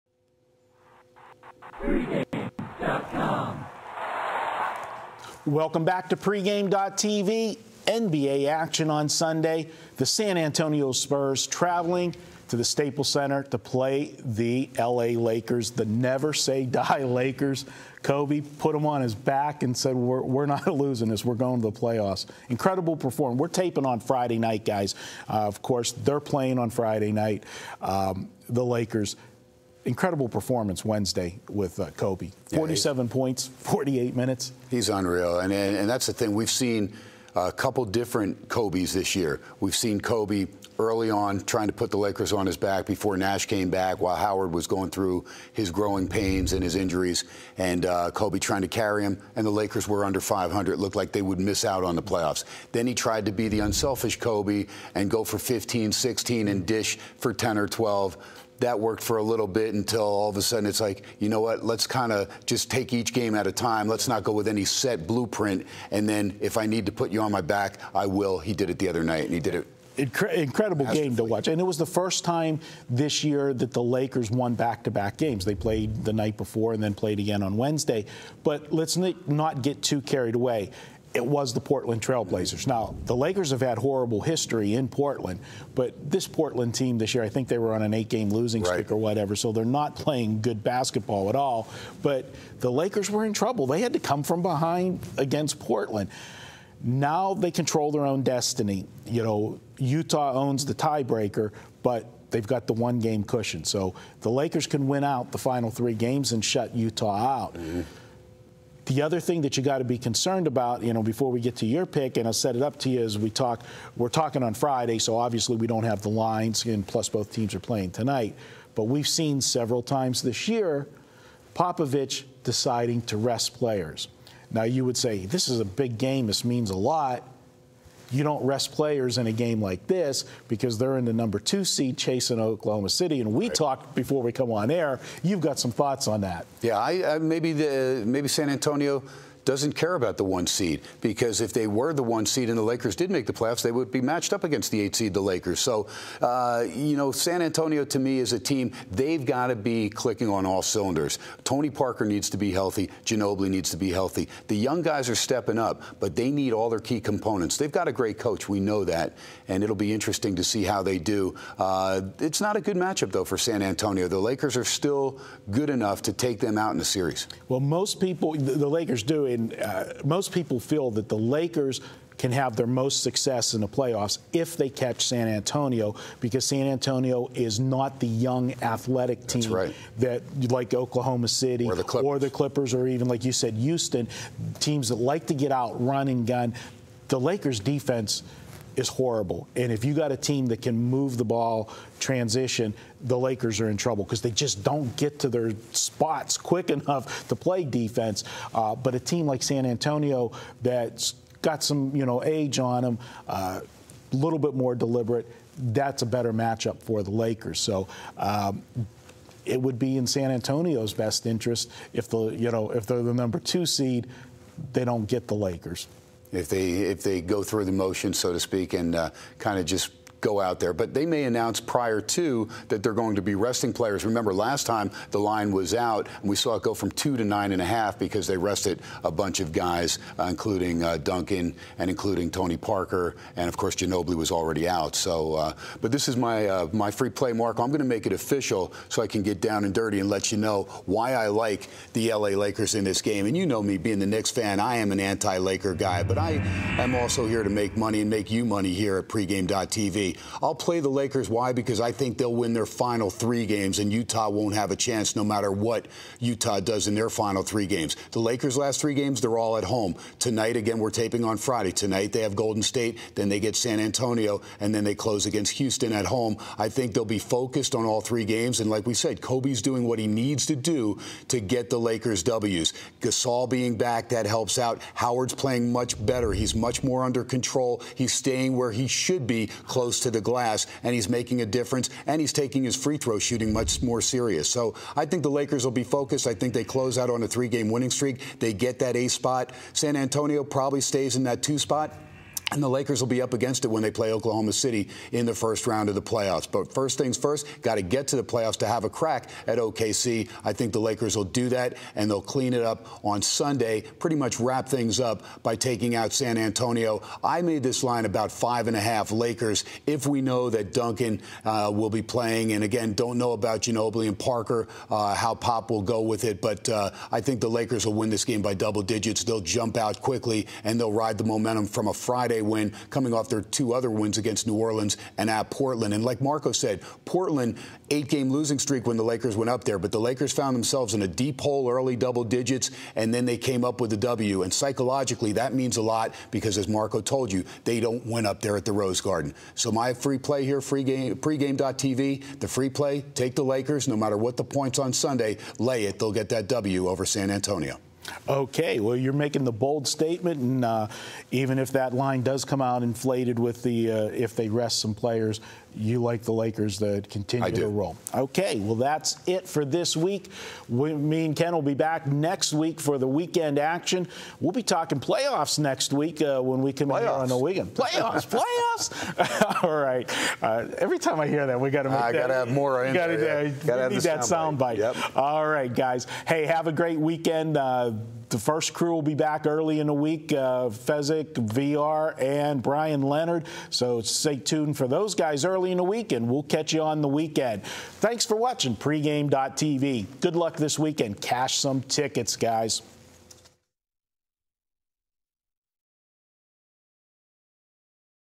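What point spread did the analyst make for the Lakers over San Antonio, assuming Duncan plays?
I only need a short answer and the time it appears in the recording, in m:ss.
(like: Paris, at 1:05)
5.5, at 5:08.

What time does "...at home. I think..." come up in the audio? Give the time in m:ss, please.
4:25.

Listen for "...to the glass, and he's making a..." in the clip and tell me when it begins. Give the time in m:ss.
4:40.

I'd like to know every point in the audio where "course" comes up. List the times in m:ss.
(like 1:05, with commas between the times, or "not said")
0:25, 3:53.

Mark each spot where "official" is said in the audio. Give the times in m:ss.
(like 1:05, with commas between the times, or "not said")
3:58.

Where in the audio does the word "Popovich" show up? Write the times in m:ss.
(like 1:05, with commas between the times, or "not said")
2:01.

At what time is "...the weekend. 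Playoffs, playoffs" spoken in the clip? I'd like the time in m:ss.
6:07.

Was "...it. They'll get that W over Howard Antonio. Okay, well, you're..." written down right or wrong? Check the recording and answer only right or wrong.
wrong.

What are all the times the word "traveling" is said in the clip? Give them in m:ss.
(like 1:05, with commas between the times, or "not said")
0:11.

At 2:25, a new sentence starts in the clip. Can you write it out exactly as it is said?
So, uh, you know, San Antonio to me is a team, they've got to be clicking on all cylinders.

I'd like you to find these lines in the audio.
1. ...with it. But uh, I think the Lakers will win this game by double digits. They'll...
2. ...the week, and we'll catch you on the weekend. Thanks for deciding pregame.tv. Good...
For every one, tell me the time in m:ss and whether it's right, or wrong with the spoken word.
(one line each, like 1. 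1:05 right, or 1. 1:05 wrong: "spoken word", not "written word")
1. 5:16 right
2. 6:25 wrong: "watching", not "deciding".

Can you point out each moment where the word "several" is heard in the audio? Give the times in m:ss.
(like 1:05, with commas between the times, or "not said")
1:59.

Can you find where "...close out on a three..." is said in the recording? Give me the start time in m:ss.
4:46.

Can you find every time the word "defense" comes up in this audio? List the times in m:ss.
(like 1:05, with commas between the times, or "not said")
3:07, 3:17.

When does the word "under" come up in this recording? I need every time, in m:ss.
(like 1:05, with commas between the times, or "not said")
0:50, 4:37.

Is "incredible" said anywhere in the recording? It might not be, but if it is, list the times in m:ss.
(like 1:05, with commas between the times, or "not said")
0:22, 0:29, 1:09.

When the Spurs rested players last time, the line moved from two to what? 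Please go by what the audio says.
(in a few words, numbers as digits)
9.5.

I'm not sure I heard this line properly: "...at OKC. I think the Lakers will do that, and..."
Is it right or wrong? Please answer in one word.
right.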